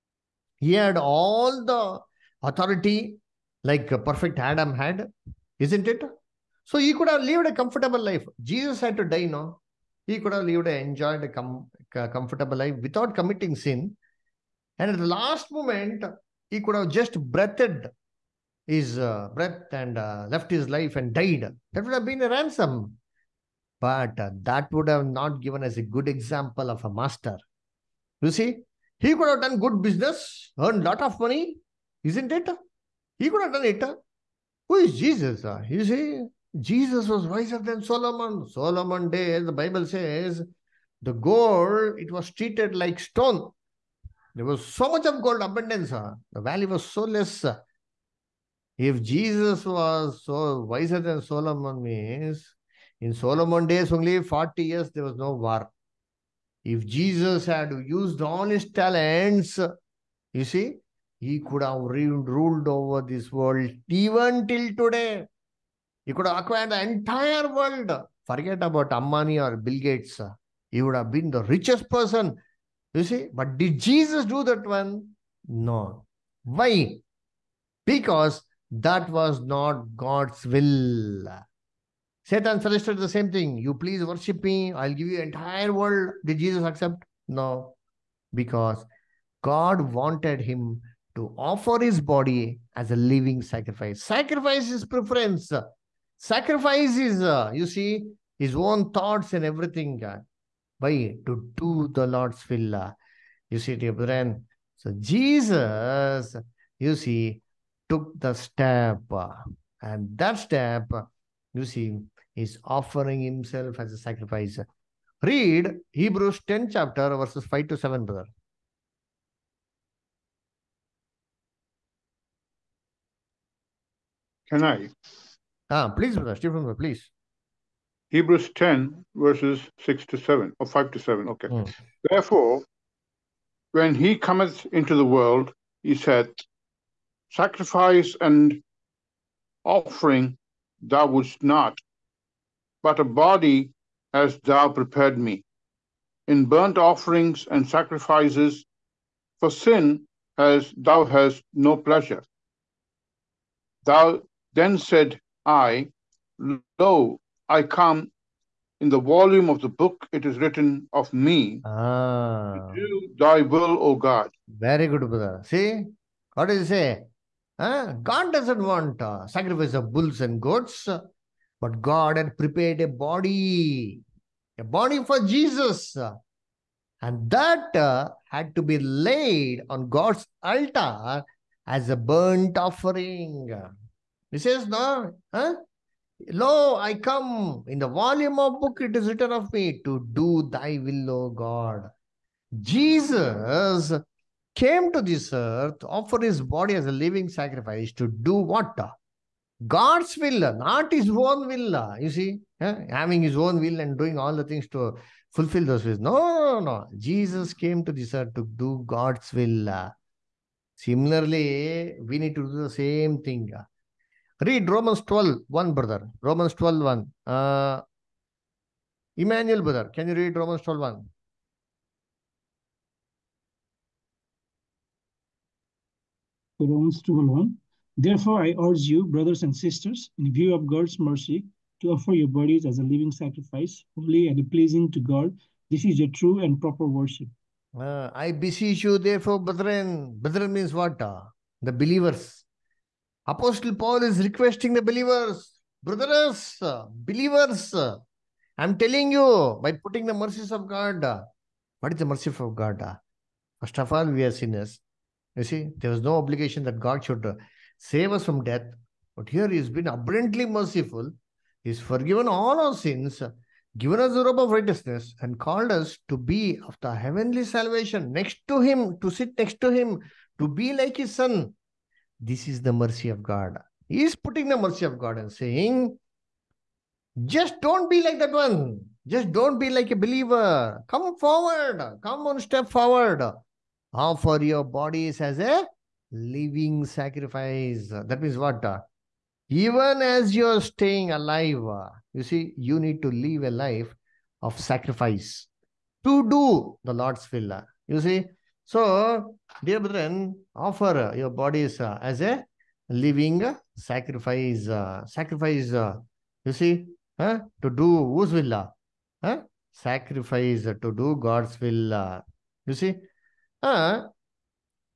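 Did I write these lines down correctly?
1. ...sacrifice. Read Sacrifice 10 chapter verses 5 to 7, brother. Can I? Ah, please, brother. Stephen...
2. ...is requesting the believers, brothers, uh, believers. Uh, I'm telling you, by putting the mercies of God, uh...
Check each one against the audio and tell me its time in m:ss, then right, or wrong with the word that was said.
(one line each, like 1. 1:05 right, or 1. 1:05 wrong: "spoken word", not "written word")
1. 1:53 wrong: "Hebrews", not "Sacrifice"
2. 4:04 right.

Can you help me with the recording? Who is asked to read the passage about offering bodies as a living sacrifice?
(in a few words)
Emmanuel.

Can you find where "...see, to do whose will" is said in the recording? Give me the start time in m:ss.
5:06.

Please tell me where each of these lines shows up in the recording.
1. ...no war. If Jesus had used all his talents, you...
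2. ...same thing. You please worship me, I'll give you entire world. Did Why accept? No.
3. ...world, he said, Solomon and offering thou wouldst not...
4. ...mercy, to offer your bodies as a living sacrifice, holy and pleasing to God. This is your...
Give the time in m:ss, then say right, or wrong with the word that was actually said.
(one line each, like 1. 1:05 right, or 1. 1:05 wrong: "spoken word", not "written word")
1. 0:55 right
2. 1:23 wrong: "Jesus", not "Why"
3. 2:15 wrong: "Sacrifice", not "Solomon"
4. 3:50 right.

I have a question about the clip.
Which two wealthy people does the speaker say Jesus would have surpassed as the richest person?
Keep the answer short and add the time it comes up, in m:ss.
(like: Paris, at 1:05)
Ambani or Bill Gates, at 1:08.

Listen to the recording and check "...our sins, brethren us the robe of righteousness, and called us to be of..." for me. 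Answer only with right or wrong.
wrong.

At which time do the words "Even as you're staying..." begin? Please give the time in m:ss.
4:49.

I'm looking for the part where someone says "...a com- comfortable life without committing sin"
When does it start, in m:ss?
0:11.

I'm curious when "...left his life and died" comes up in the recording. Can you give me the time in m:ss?
0:20.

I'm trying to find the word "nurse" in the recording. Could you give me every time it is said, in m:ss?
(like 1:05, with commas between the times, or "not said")
not said.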